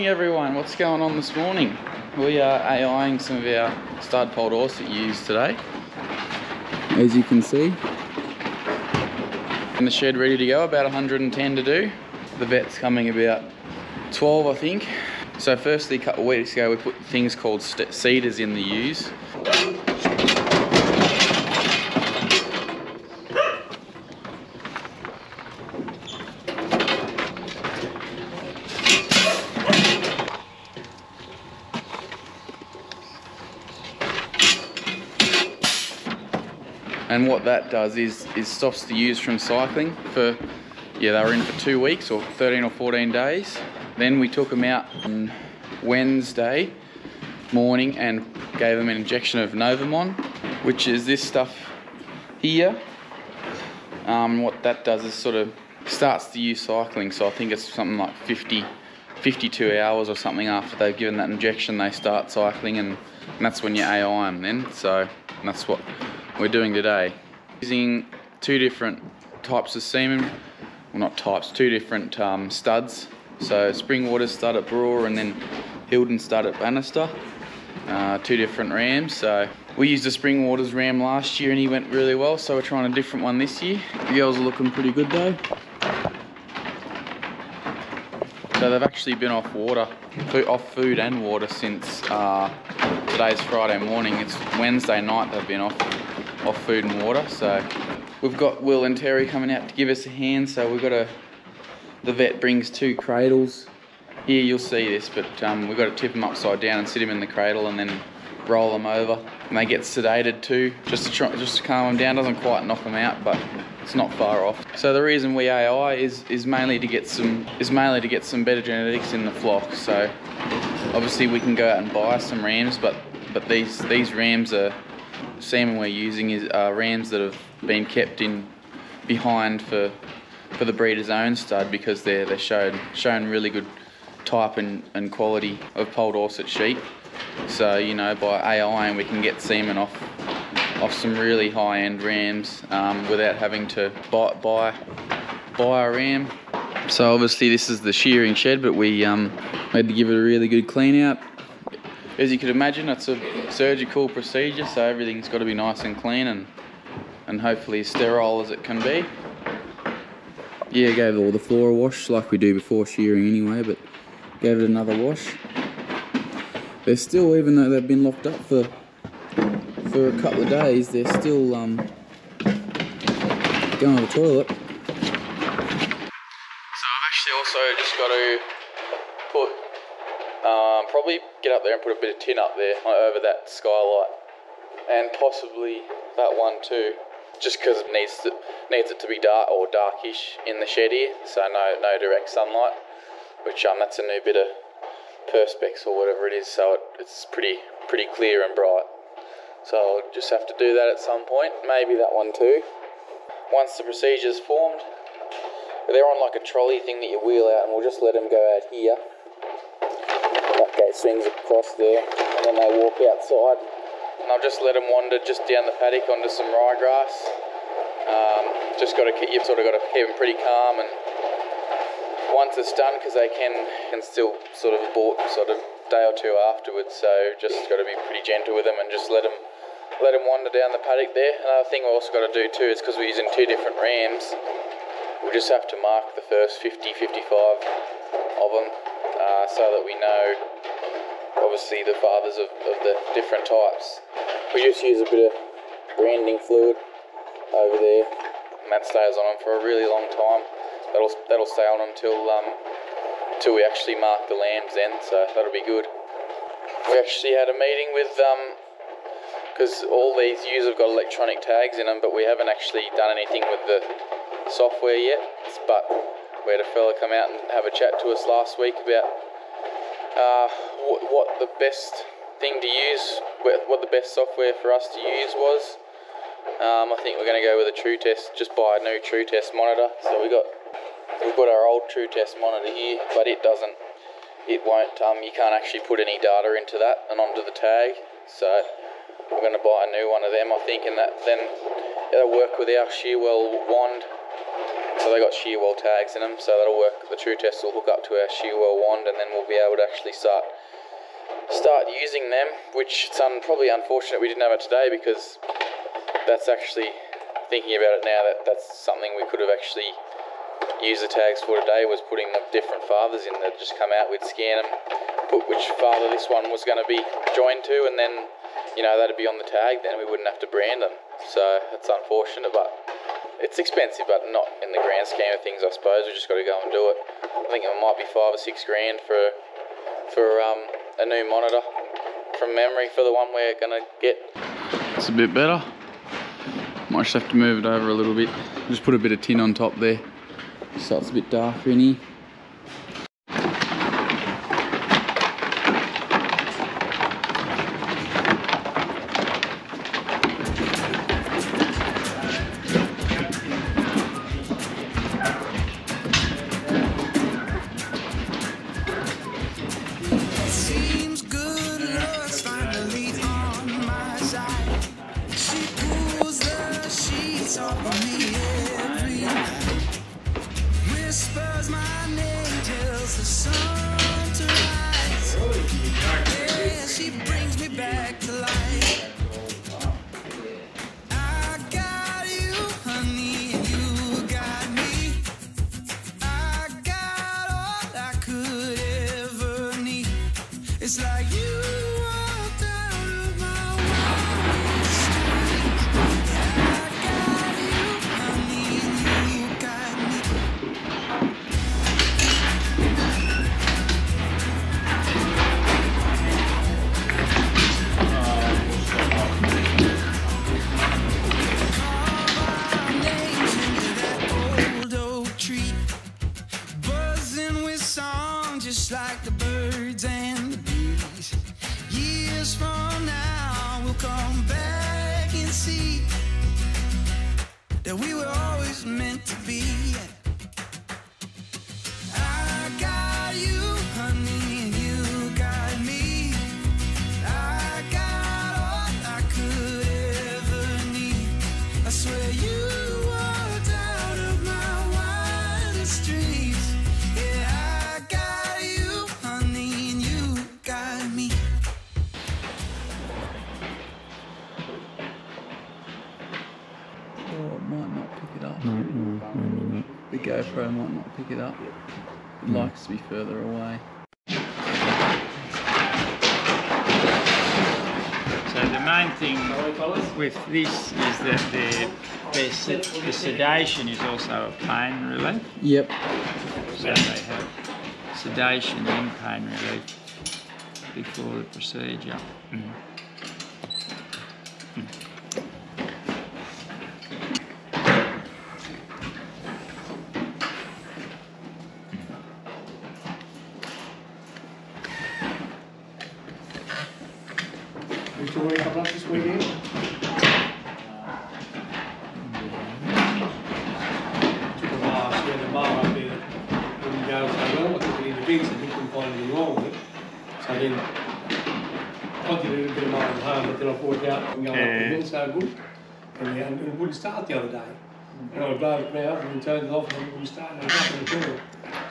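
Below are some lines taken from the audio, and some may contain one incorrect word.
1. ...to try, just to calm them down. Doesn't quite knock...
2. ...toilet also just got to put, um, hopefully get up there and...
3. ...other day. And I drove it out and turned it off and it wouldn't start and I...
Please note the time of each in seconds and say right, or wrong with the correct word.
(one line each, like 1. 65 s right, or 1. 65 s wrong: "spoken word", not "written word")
1. 111 s right
2. 174 s wrong: "probably", not "hopefully"
3. 517 s right.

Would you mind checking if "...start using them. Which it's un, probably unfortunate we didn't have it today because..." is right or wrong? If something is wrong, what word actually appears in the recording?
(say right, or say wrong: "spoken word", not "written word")
right.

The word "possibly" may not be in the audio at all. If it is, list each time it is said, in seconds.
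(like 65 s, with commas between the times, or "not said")
185 s.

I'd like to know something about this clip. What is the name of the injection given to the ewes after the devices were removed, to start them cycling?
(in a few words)
Novormon.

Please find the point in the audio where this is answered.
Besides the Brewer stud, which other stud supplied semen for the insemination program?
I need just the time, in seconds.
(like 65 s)
75 s.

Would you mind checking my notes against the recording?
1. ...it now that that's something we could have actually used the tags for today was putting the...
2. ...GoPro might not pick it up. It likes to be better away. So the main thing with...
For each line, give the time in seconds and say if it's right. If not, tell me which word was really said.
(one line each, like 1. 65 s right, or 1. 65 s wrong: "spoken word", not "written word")
1. 308 s right
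2. 460 s wrong: "further", not "better".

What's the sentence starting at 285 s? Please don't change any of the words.
Um, you can't actually put any data into that and onto the tag.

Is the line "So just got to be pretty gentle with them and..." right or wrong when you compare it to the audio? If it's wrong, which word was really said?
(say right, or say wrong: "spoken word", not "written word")
right.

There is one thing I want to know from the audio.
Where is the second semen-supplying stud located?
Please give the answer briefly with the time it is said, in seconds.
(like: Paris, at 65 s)
Bannister, at 76 s.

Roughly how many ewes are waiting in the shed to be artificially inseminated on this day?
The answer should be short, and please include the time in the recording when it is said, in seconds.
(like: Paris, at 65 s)
110, at 10 s.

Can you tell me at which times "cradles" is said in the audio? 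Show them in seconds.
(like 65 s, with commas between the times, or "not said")
102 s, 107 s.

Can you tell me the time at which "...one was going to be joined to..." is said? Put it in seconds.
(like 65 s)
316 s.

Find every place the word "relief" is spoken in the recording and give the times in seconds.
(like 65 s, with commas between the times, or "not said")
475 s, 479 s.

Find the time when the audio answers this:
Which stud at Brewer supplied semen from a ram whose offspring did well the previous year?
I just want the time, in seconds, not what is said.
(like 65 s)
73 s.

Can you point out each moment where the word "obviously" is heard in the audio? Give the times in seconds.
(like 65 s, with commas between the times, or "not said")
120 s, 147 s, 241 s.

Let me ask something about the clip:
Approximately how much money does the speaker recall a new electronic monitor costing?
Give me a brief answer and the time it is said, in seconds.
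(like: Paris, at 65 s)
5 or 6 grand, at 328 s.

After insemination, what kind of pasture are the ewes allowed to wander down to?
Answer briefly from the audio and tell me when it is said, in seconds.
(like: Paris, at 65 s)
Ryegrass, at 216 s.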